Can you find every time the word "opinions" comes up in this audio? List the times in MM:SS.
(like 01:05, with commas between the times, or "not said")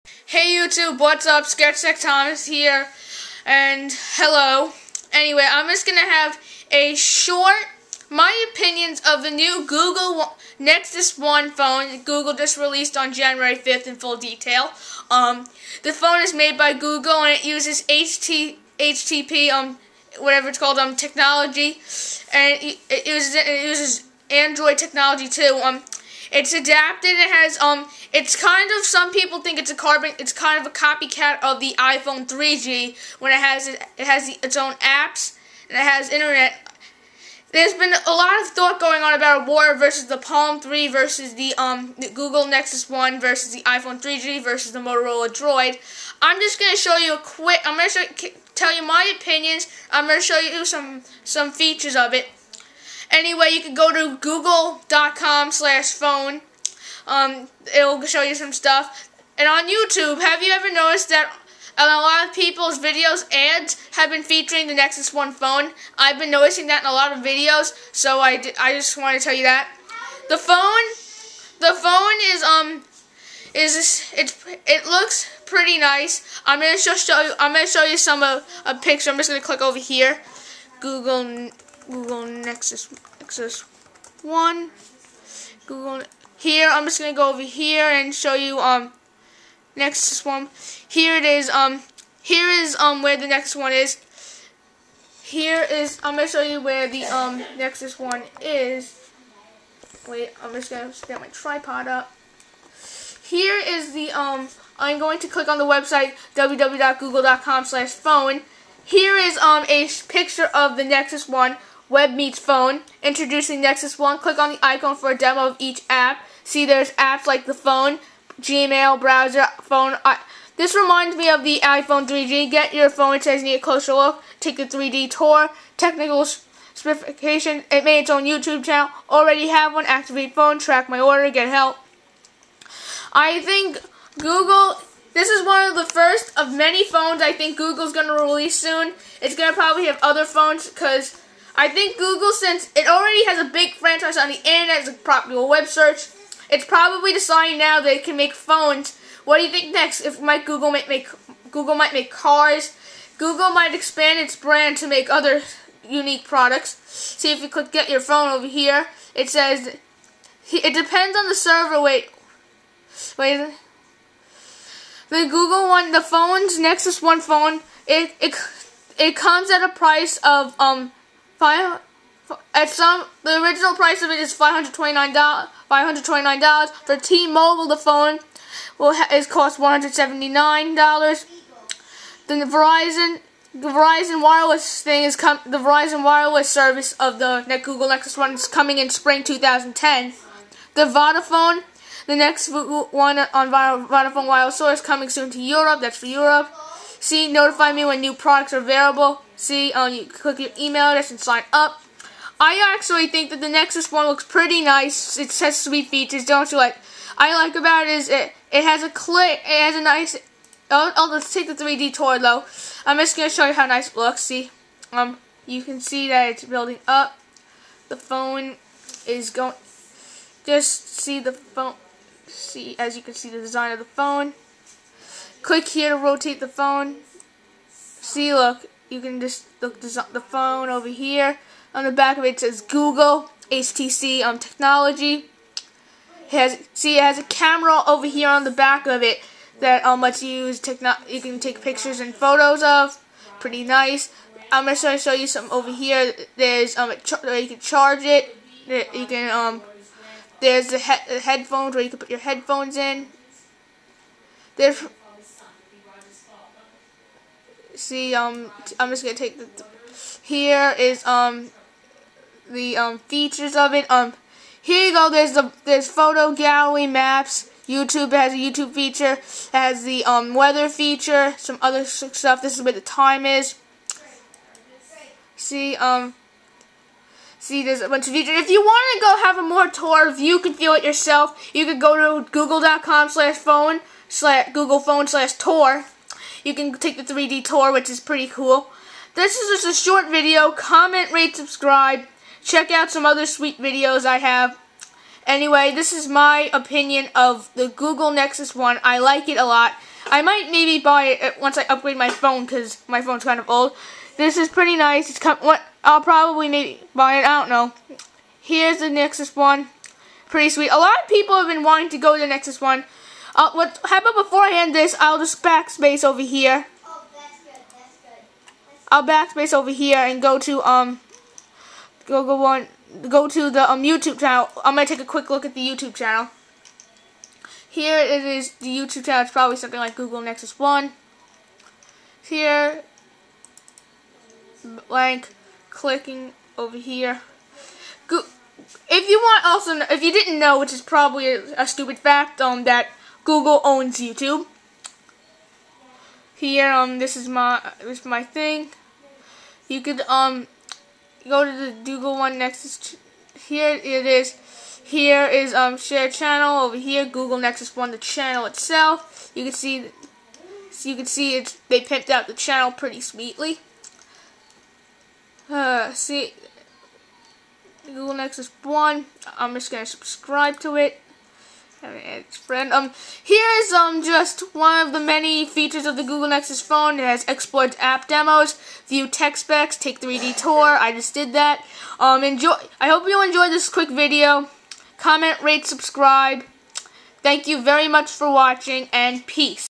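00:08, 00:49, 04:56.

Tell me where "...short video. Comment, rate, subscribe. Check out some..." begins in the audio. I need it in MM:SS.
04:49.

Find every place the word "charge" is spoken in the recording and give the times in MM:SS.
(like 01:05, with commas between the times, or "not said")
04:07.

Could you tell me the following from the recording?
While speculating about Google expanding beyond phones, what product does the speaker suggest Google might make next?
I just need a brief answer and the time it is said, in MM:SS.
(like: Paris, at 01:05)
Cars, at 02:32.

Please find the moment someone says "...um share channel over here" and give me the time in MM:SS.
05:55.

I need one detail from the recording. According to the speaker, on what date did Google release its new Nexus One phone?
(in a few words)
January 5th.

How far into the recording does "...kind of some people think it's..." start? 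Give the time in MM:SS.
00:28.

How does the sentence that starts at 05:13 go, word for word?
Uh, what happened about before I'll just backspace over here.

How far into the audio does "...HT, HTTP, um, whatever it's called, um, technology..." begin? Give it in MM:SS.
00:17.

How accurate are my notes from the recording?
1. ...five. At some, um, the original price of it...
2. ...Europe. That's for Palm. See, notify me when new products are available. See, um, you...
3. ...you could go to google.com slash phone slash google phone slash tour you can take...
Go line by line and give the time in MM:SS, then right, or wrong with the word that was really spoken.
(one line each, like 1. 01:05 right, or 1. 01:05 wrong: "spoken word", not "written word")
1. 02:51 right
2. 03:15 wrong: "Europe", not "Palm"
3. 04:41 right.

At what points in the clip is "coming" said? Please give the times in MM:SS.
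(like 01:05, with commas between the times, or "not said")
03:08, 03:14.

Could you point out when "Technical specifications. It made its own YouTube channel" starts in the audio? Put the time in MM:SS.
02:05.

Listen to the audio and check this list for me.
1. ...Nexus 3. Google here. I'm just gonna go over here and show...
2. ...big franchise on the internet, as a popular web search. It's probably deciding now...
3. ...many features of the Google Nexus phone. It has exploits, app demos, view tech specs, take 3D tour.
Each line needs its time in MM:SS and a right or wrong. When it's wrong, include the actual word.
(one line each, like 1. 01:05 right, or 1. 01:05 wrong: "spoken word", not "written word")
1. 01:23 wrong: "1", not "3"
2. 02:23 right
3. 06:14 right.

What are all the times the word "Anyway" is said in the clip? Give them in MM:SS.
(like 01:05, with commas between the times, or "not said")
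00:05, 00:53, 04:55.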